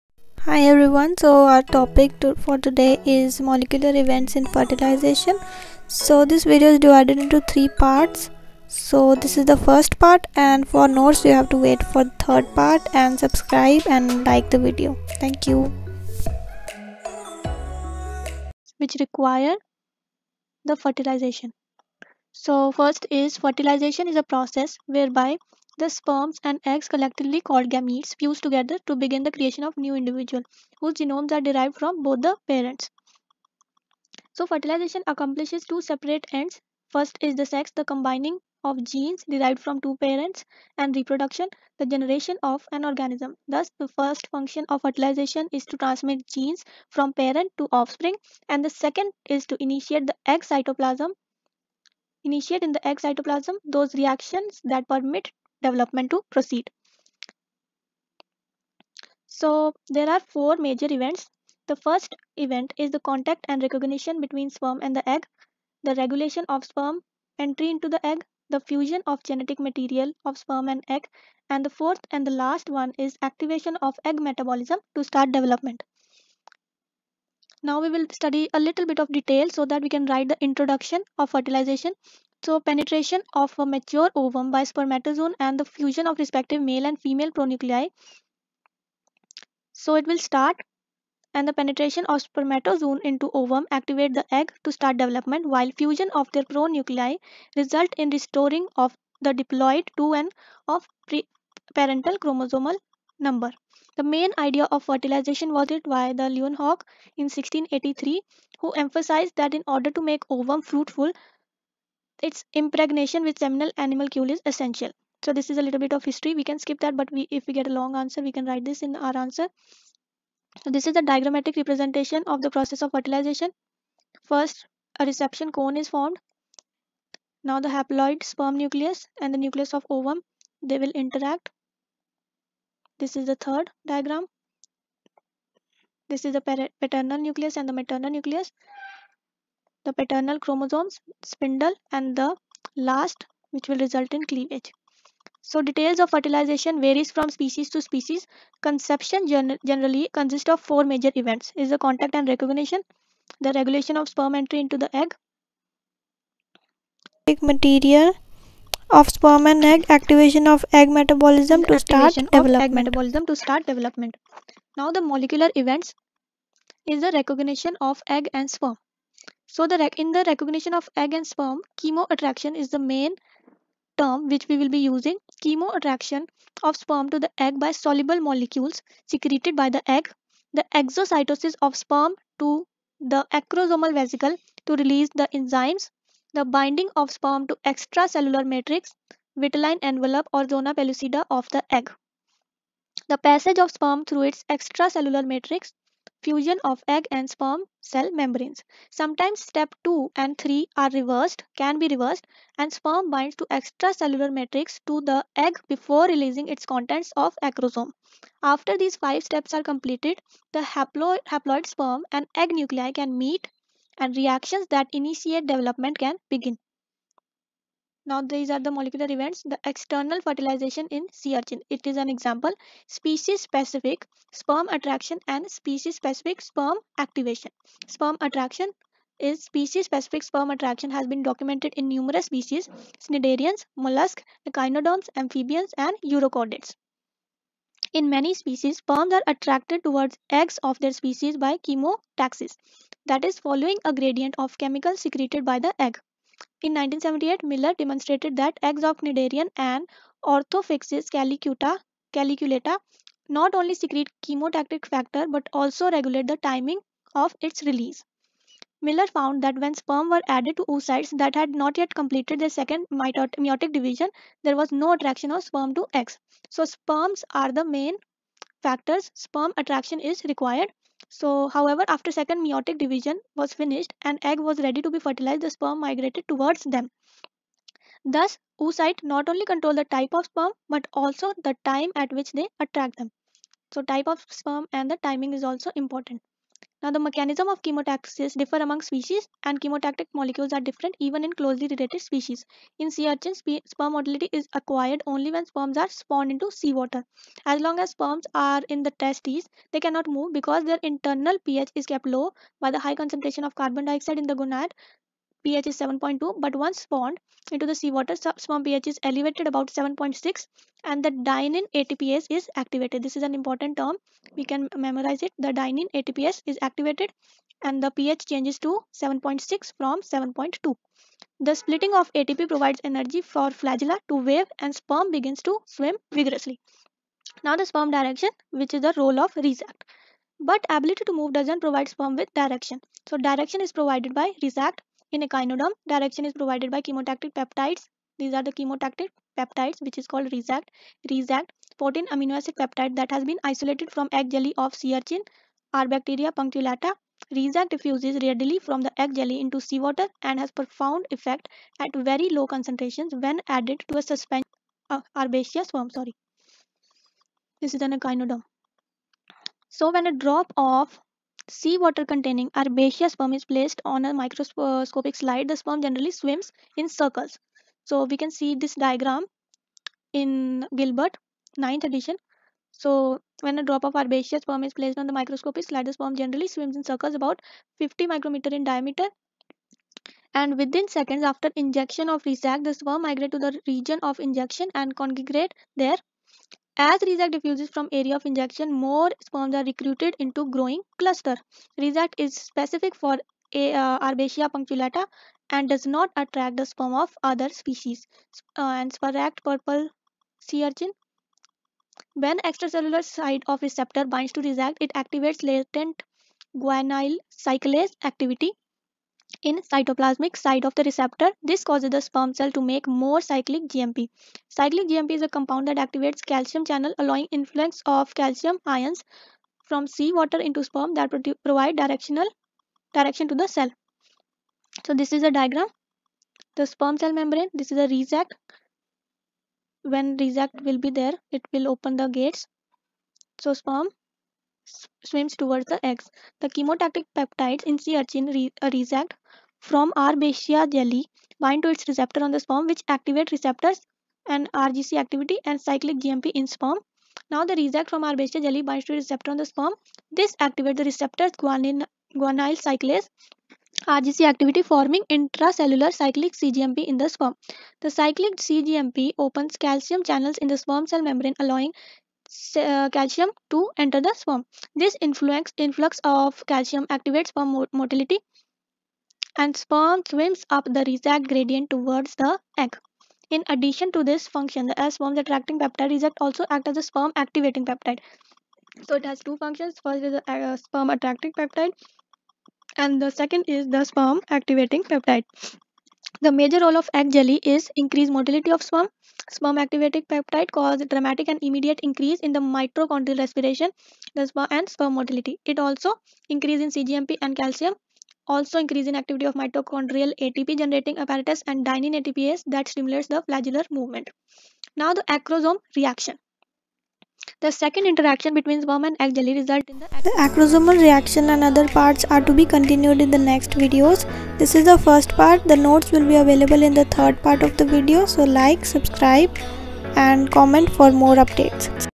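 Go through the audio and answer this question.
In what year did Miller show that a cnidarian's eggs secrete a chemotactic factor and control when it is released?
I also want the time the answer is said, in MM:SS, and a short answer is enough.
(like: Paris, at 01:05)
1978, at 04:06.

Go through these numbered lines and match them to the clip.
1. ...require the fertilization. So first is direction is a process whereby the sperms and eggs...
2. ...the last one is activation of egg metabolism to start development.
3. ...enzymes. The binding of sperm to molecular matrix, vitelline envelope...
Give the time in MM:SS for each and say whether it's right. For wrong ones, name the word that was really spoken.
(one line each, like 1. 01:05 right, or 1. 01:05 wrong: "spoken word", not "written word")
1. 00:18 wrong: "fertilization", not "direction"
2. 01:12 right
3. 03:05 wrong: "extracellular", not "molecular".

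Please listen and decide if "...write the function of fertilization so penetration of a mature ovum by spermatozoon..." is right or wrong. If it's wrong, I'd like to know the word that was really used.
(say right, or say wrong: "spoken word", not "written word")
wrong: "introduction", not "function".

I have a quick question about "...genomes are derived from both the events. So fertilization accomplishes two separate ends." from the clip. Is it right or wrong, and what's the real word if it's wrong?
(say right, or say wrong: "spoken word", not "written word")
wrong: "parents", not "events".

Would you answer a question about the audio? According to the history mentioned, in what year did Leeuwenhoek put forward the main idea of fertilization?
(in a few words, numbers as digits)
1683.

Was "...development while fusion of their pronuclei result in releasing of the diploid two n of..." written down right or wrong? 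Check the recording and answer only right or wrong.
wrong.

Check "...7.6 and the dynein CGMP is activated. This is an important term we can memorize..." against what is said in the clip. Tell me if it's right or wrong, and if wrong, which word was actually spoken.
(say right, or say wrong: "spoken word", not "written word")
wrong: "ATPase", not "CGMP".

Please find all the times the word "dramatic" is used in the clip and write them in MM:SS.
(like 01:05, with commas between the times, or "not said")
08:10.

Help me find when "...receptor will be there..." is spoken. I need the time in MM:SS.
07:10.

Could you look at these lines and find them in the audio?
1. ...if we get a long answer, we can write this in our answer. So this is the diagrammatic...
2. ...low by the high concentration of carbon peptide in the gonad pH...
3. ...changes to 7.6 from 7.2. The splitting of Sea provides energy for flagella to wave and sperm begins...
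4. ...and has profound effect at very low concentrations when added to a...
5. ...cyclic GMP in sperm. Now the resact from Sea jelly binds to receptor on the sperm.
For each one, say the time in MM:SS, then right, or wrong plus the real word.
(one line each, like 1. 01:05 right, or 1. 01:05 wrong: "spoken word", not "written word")
1. 01:57 right
2. 05:02 wrong: "dioxide", not "peptide"
3. 05:18 wrong: "ATP", not "Sea"
4. 05:50 right
5. 07:25 wrong: "Arbacia", not "Sea".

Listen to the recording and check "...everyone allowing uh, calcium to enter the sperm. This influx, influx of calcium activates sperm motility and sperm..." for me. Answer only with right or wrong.
wrong.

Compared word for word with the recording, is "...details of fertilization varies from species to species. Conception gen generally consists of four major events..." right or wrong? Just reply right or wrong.
right.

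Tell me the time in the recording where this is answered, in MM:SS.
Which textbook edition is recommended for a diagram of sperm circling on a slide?
06:10.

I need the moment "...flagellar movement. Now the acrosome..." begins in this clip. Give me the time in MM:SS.
08:23.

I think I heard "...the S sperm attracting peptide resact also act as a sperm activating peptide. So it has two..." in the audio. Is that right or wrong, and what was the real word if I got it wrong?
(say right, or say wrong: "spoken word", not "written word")
right.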